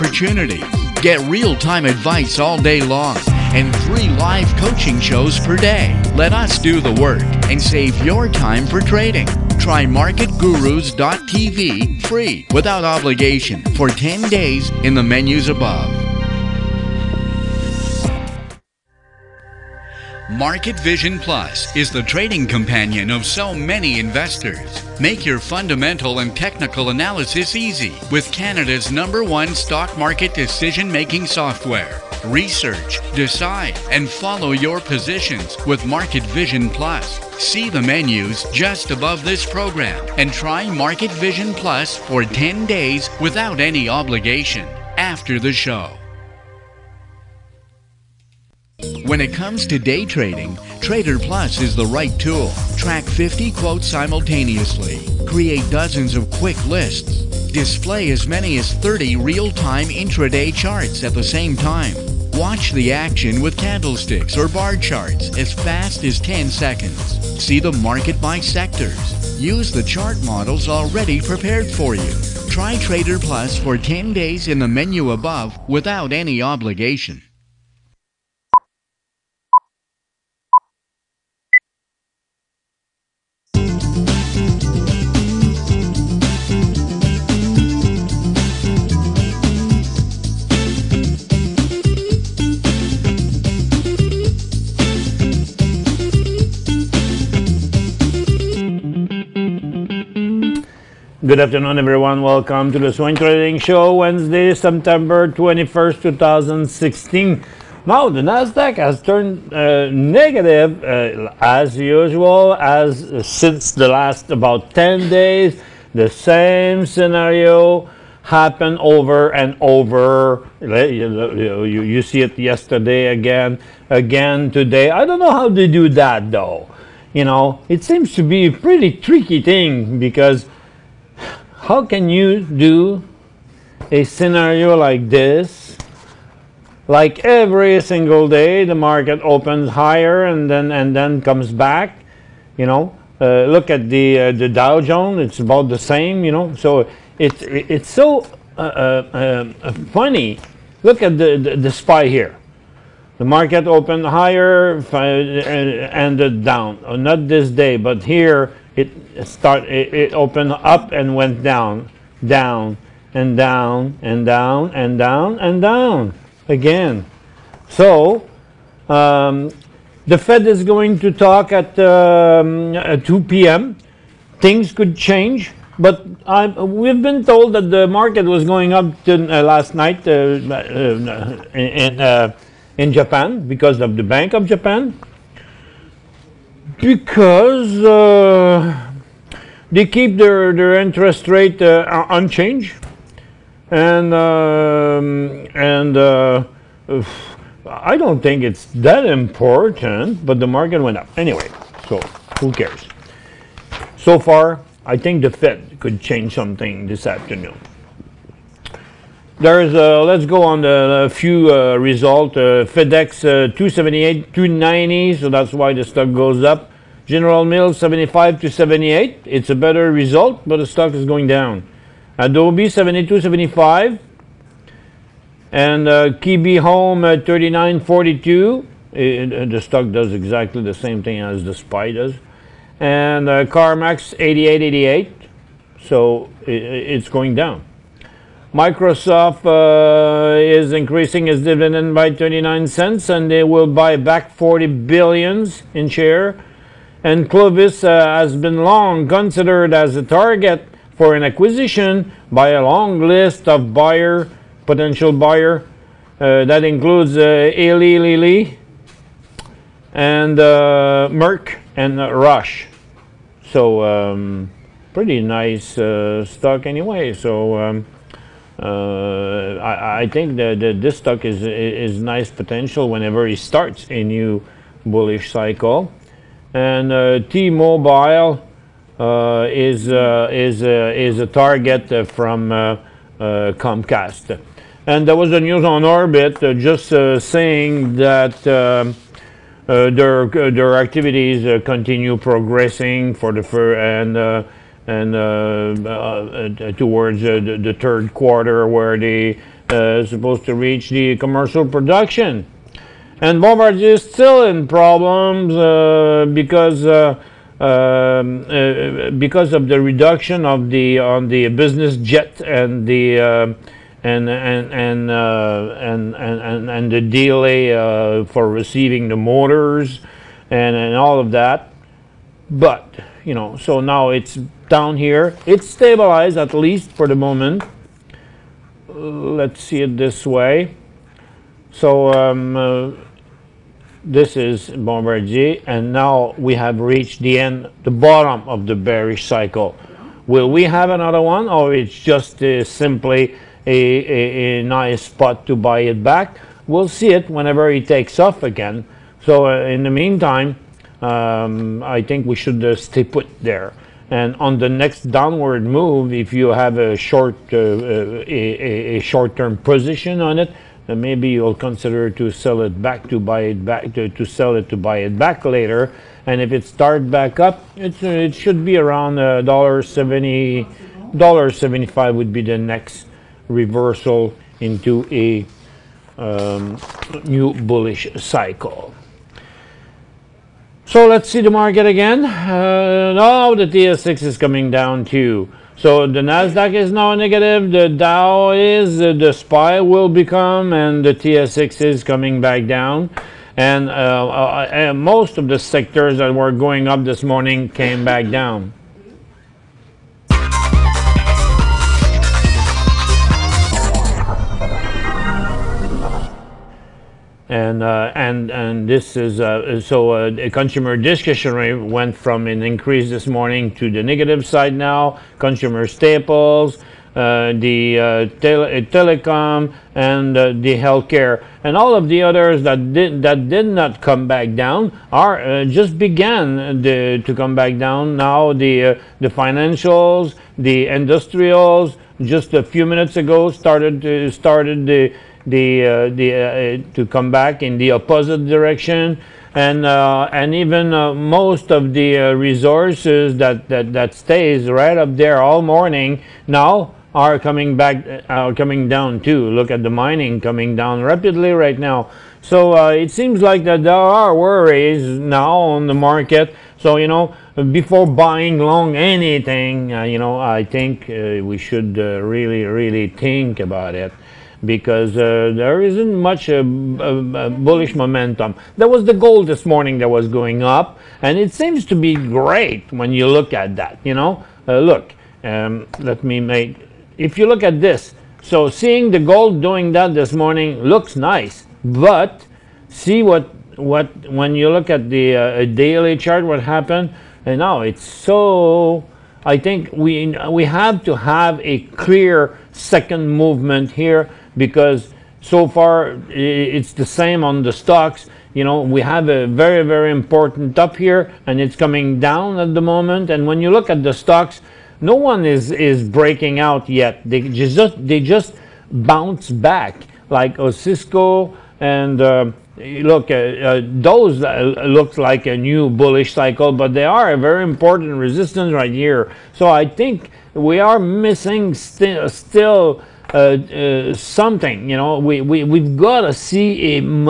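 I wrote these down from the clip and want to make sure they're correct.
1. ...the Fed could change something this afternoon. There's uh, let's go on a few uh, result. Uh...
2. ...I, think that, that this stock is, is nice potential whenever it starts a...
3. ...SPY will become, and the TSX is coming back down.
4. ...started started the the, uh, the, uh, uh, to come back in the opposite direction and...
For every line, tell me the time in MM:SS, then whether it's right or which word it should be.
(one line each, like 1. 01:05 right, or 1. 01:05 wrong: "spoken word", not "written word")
1. 03:25 right
2. 04:30 right
3. 06:29 right
4. 07:13 right.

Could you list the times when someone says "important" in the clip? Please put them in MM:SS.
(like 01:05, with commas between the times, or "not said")
03:19, 08:20, 08:37.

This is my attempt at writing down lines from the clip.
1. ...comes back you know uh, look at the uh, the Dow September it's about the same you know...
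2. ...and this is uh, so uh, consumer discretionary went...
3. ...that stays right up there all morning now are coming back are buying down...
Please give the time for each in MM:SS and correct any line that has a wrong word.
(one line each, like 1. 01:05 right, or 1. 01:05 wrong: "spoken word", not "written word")
1. 02:21 wrong: "Jones", not "September"
2. 06:48 right
3. 07:23 wrong: "coming", not "buying".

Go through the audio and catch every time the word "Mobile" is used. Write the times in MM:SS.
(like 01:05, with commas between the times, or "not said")
04:37.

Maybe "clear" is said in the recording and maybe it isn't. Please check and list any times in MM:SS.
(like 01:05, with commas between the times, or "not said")
08:11.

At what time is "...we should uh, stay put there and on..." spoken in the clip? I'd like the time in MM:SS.
05:52.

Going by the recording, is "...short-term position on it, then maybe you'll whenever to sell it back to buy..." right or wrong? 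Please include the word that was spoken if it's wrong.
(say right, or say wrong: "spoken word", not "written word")
wrong: "consider", not "whenever".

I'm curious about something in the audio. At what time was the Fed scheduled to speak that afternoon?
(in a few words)
2 p.m.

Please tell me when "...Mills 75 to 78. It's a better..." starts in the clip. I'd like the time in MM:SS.
03:37.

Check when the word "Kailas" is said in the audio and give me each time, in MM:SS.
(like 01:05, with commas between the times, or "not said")
not said.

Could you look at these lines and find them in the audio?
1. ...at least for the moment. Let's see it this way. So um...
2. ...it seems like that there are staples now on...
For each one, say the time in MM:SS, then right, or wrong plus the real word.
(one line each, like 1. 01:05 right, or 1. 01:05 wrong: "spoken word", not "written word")
1. 05:26 right
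2. 07:32 wrong: "worries", not "staples".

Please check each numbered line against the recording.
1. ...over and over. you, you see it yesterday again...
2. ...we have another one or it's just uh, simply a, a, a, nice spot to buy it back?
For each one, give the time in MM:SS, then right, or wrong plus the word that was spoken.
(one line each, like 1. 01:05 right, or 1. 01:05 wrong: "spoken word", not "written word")
1. 01:58 right
2. 05:40 right.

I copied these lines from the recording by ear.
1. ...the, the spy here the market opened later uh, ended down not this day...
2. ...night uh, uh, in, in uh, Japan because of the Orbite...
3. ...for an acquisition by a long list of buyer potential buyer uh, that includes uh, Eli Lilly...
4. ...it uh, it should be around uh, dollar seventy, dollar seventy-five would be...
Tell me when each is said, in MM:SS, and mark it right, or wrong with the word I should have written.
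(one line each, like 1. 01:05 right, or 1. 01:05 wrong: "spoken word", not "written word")
1. 02:31 wrong: "higher", not "later"
2. 02:59 wrong: "Bank", not "Orbite"
3. 04:10 right
4. 06:07 right.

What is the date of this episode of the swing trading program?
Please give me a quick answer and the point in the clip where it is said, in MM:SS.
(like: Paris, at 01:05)
September 21st, 2016, at 01:44.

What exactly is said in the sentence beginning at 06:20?
So let's see the market again.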